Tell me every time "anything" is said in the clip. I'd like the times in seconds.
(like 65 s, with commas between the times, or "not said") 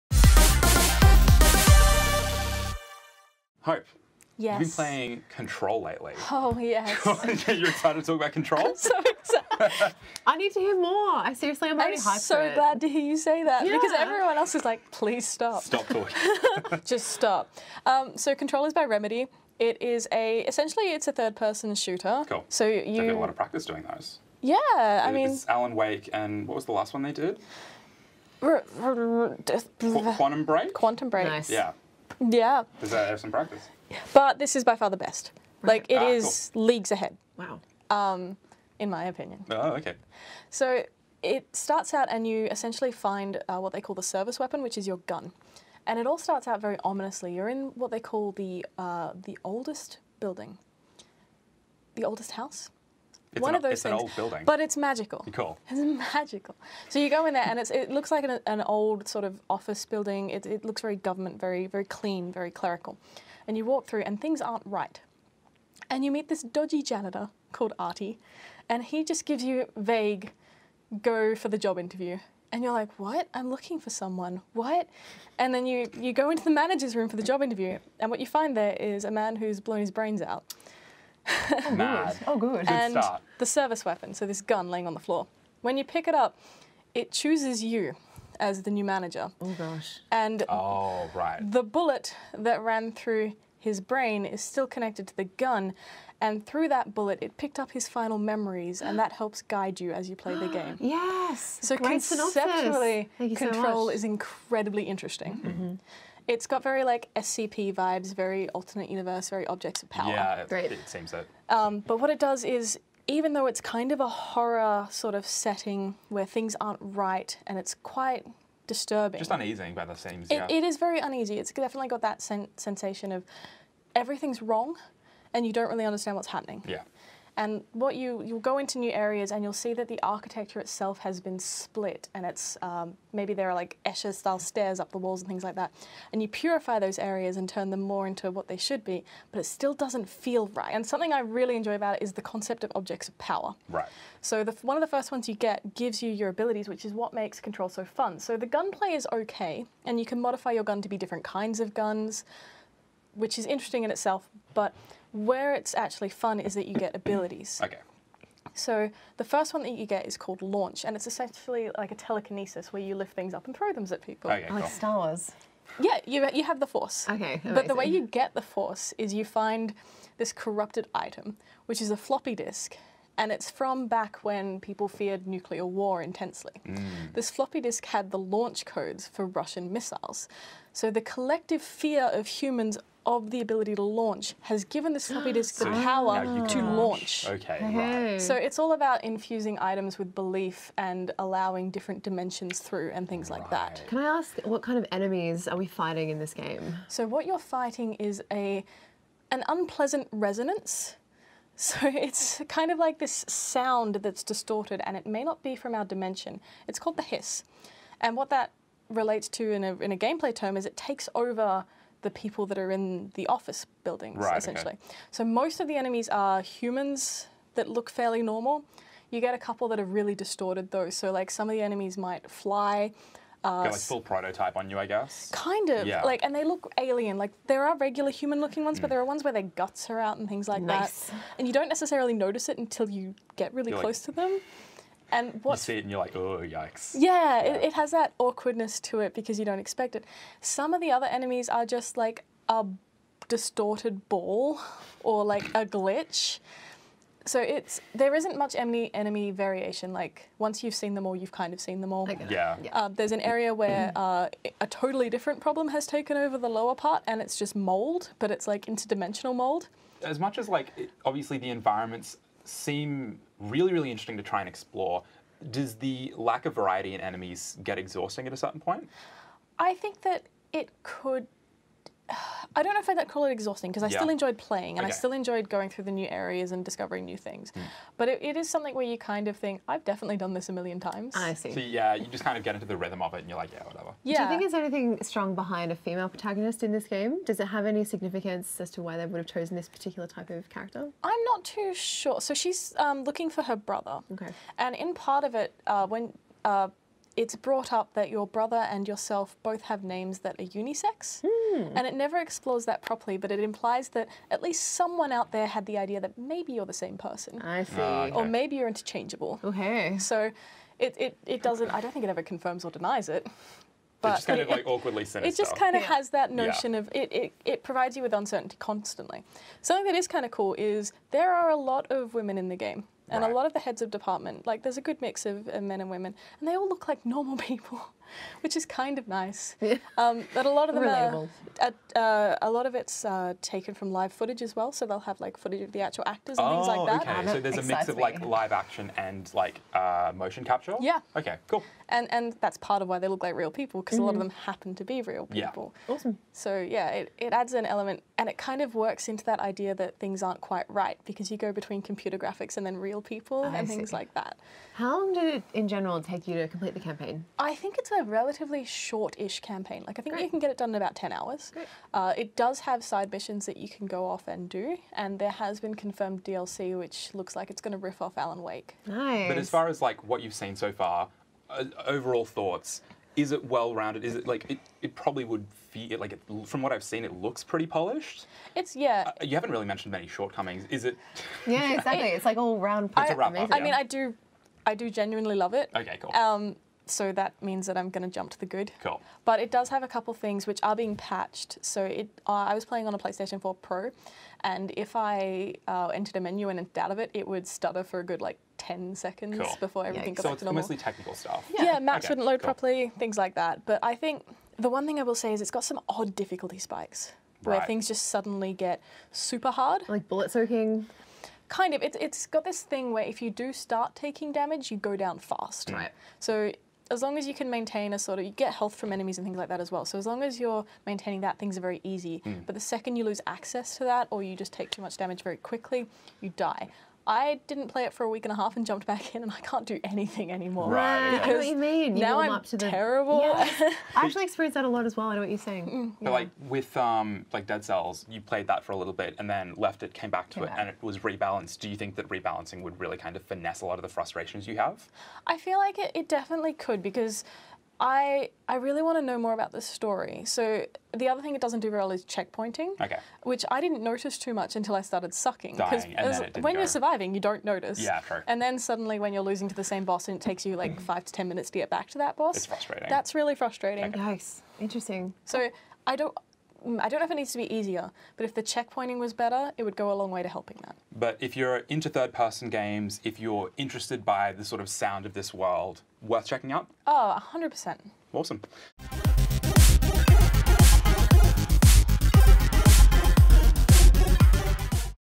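284 s, 429 s.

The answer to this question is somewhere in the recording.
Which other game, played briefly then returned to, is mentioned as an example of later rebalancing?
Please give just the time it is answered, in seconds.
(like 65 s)
437 s.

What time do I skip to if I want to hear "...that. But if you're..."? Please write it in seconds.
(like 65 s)
470 s.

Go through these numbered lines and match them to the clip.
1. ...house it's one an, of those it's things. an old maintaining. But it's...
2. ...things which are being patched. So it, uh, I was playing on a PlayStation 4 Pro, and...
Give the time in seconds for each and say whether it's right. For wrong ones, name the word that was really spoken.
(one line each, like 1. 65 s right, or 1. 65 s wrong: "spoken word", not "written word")
1. 52 s wrong: "building", not "maintaining"
2. 390 s right.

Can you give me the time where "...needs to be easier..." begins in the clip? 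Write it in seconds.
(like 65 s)
467 s.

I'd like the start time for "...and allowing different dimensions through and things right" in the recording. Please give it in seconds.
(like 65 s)
190 s.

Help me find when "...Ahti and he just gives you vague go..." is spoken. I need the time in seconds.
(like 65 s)
67 s.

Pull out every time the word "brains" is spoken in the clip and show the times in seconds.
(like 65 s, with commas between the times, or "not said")
79 s, 93 s.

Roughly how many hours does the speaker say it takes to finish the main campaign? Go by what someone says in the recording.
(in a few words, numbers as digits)
10 hours.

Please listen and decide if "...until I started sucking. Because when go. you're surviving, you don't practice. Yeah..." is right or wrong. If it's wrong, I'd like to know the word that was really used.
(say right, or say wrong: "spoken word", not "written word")
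wrong: "notice", not "practice".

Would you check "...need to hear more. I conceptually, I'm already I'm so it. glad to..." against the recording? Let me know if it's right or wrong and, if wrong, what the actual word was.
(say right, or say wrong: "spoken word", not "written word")
wrong: "seriously", not "conceptually".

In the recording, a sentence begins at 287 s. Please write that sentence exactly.
Does it have any significance as to why they would have chosen this particular type of character?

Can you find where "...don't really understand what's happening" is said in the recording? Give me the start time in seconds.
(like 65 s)
125 s.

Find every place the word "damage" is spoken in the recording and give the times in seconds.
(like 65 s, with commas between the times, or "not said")
414 s, 424 s.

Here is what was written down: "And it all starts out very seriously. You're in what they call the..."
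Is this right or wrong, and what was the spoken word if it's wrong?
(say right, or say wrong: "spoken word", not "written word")
wrong: "ominously", not "seriously".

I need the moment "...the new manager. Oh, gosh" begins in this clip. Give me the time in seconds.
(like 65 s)
88 s.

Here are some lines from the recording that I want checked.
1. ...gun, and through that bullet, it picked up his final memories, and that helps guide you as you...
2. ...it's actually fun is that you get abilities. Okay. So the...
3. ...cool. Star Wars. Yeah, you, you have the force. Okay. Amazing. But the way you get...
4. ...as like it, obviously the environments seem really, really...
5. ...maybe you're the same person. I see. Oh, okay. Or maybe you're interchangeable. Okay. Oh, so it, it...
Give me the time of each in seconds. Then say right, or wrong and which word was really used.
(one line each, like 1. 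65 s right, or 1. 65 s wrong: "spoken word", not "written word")
1. 95 s right
2. 155 s right
3. 164 s right
4. 260 s right
5. 306 s right.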